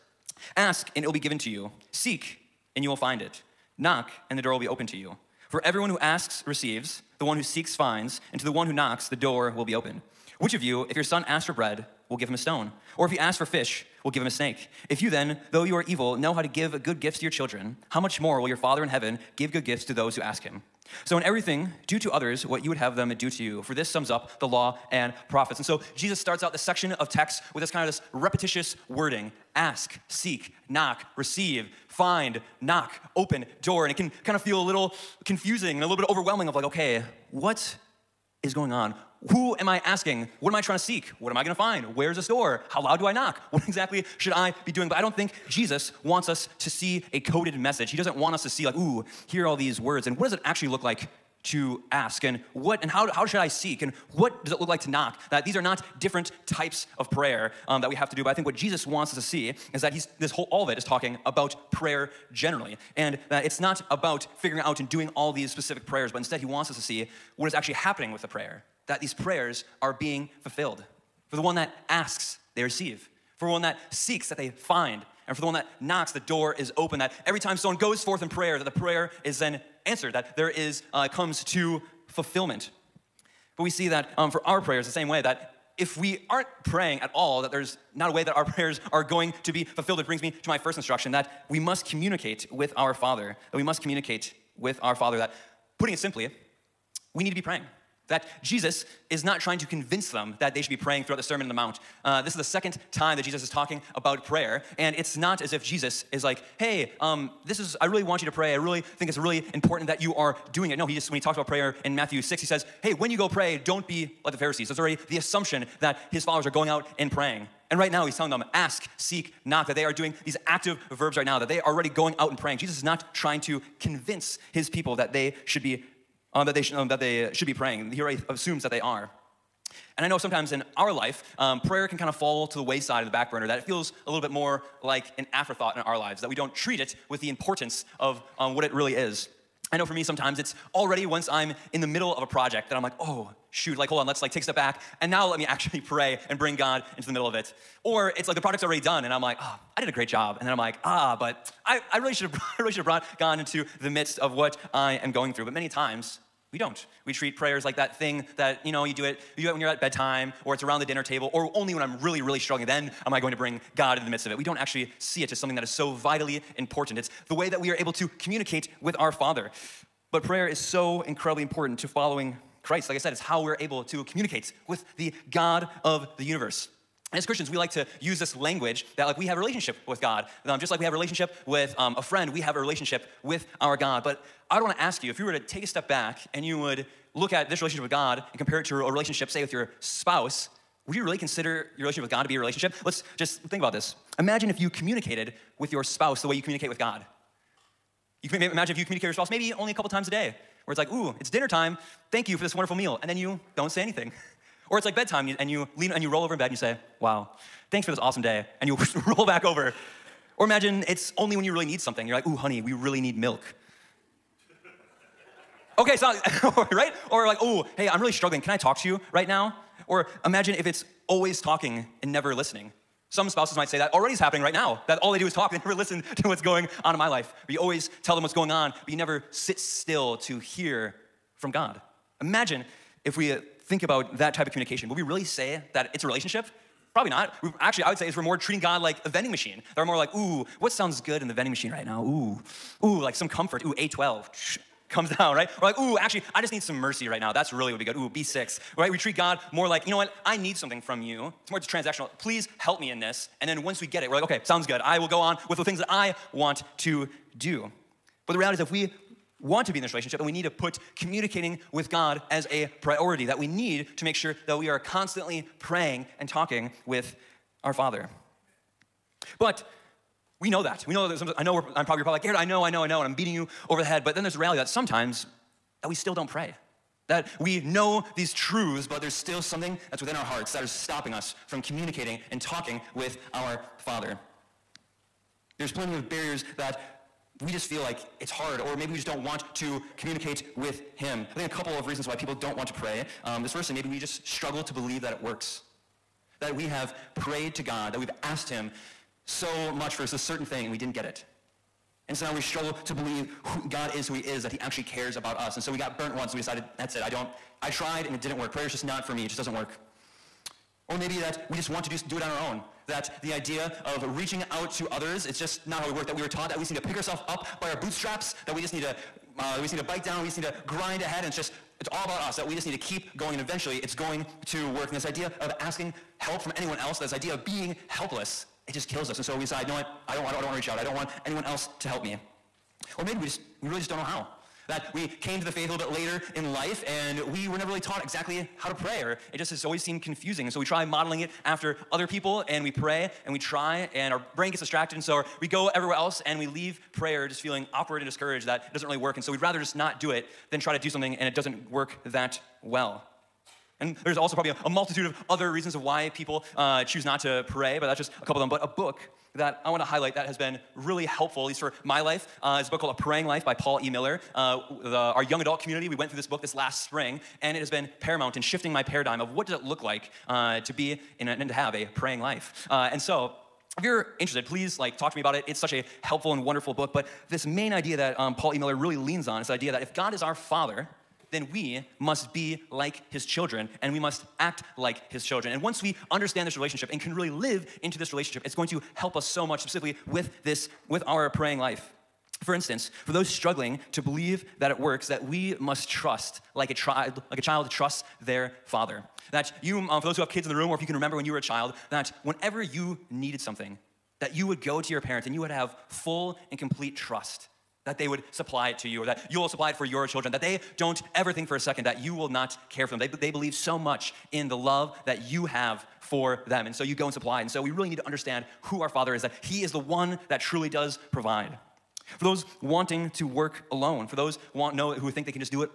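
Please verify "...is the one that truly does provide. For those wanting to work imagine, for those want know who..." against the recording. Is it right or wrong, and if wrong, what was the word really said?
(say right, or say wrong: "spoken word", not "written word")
wrong: "alone", not "imagine".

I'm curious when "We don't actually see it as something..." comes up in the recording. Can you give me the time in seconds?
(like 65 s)
164 s.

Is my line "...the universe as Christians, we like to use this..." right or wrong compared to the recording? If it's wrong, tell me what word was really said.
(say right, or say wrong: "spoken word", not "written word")
right.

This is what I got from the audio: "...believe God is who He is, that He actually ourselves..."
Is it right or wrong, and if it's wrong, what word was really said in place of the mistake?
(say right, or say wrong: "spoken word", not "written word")
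wrong: "cares", not "ourselves".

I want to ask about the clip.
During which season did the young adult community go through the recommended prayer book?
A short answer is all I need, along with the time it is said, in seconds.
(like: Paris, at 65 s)
Spring, at 366 s.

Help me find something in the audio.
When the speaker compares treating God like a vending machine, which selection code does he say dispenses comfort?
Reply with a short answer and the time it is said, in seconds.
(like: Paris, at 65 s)
A12, at 243 s.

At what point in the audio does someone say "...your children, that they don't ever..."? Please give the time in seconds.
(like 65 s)
409 s.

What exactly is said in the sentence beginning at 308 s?
Prayer is just not for me, it just doesn't work.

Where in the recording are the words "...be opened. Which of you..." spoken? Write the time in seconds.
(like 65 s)
9 s.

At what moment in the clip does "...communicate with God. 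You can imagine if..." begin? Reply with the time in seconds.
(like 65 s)
196 s.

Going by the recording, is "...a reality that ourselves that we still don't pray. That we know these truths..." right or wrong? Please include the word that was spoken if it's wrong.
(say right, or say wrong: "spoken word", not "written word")
wrong: "sometimes", not "ourselves".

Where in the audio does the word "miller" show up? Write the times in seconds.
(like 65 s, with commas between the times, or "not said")
363 s, 378 s.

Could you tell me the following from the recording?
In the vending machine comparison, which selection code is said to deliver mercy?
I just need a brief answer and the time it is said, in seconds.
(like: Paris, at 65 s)
B6, at 248 s.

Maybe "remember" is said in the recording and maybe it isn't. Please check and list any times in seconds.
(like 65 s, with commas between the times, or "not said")
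400 s.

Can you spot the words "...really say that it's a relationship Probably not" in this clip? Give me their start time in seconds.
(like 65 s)
235 s.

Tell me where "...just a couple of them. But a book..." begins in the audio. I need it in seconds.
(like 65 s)
357 s.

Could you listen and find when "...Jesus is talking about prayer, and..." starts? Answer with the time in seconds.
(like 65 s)
103 s.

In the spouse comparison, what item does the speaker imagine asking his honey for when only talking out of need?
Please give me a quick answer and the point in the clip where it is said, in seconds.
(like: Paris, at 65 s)
Milk, at 213 s.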